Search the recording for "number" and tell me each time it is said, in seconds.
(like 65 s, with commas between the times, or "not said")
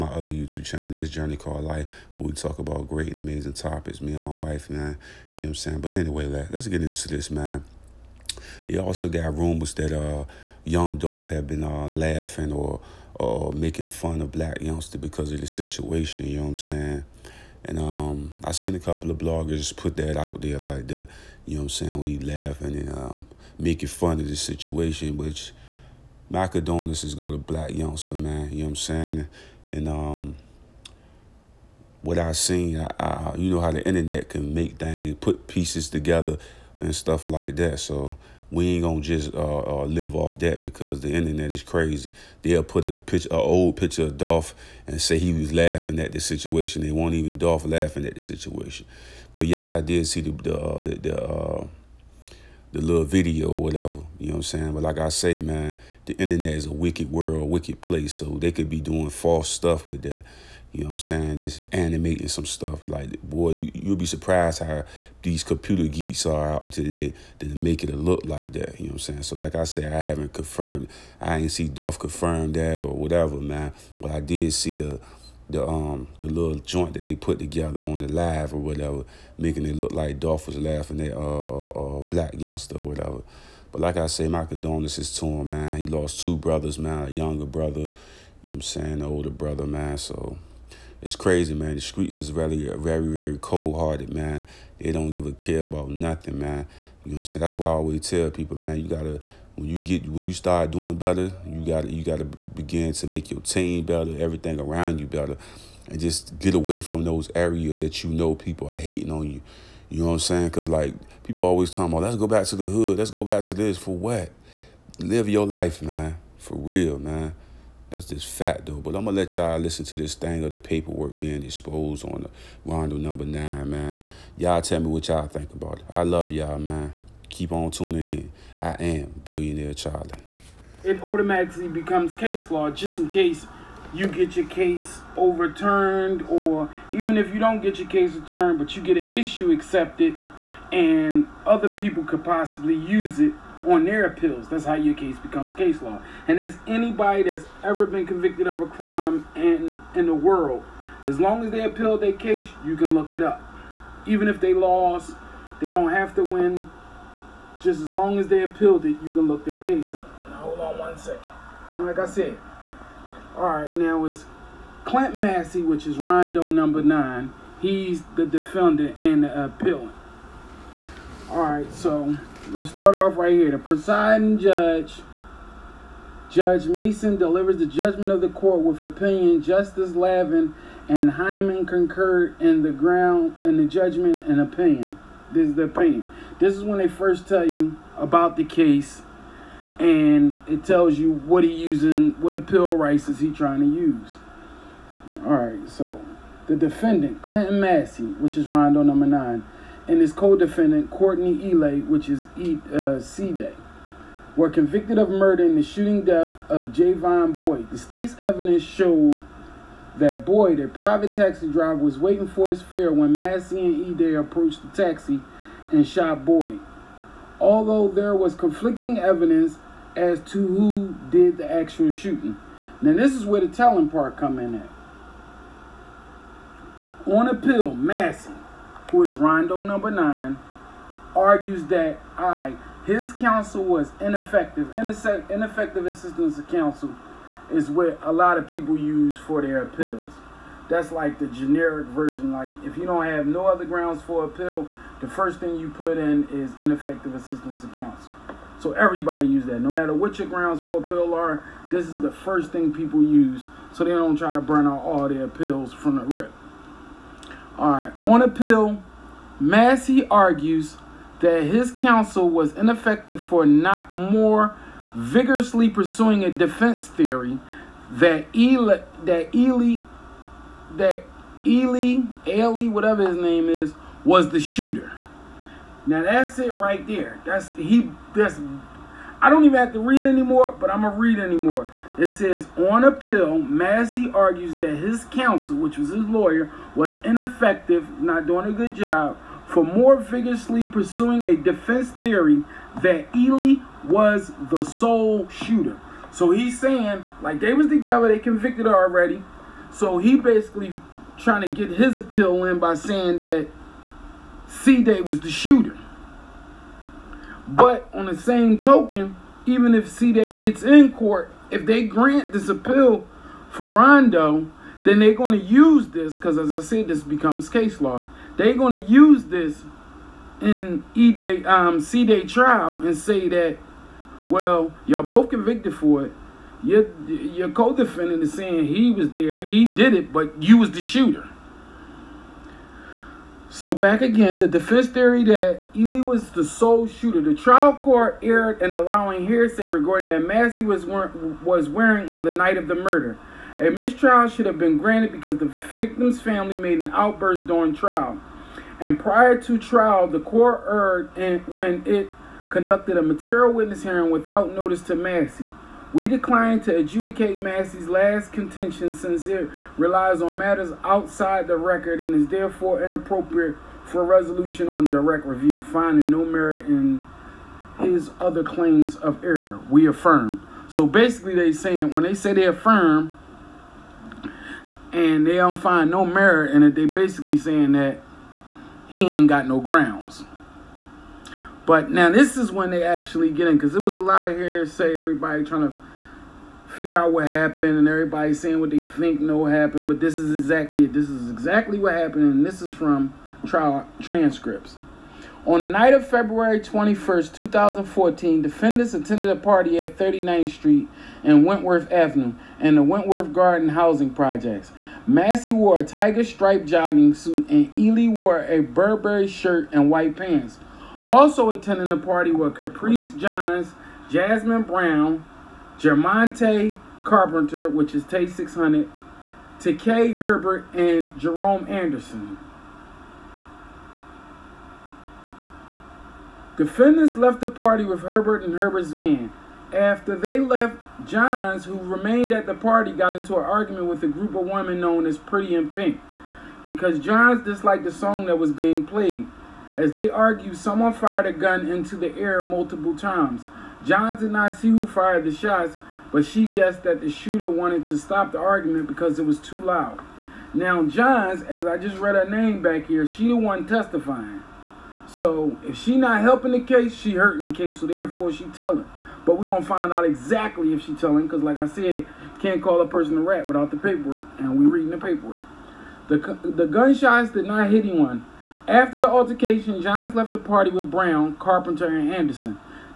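122 s, 166 s, 198 s, 229 s.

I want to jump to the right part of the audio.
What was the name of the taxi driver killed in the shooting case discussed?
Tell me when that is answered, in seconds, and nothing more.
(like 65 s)
206 s.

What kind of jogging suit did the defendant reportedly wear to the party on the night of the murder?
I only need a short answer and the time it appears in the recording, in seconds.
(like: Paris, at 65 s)
Tiger striped, at 405 s.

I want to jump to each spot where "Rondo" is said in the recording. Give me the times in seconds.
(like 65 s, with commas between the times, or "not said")
122 s, 165 s, 198 s, 229 s, 313 s.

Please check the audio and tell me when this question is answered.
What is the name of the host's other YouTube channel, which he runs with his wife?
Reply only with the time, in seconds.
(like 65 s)
0 s.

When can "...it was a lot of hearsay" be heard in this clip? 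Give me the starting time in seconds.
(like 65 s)
383 s.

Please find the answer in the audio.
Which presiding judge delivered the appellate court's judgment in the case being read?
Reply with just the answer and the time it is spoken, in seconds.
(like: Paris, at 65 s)
Judge Mason, at 176 s.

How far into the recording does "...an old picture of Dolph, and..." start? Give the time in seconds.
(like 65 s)
43 s.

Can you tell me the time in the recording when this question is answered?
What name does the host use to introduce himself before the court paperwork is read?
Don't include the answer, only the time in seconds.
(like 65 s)
129 s.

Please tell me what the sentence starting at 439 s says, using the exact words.
As they argue, someone fired a gun into the air multiple times.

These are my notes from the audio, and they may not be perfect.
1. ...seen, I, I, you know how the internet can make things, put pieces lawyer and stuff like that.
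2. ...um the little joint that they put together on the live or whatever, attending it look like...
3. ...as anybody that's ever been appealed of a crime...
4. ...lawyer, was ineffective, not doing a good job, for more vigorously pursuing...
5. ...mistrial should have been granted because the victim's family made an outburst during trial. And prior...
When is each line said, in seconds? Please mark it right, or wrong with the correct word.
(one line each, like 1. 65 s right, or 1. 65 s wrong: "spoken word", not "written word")
1. 32 s wrong: "together", not "lawyer"
2. 75 s wrong: "making", not "attending"
3. 146 s wrong: "convicted", not "appealed"
4. 286 s right
5. 343 s right.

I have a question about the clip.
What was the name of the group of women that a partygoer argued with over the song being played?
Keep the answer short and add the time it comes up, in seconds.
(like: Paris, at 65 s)
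Pretty in Pink, at 435 s.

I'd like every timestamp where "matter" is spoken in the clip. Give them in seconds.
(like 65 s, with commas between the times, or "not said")
249 s, 360 s.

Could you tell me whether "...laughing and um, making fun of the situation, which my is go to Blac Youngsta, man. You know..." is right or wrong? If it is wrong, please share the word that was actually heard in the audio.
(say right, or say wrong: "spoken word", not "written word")
right.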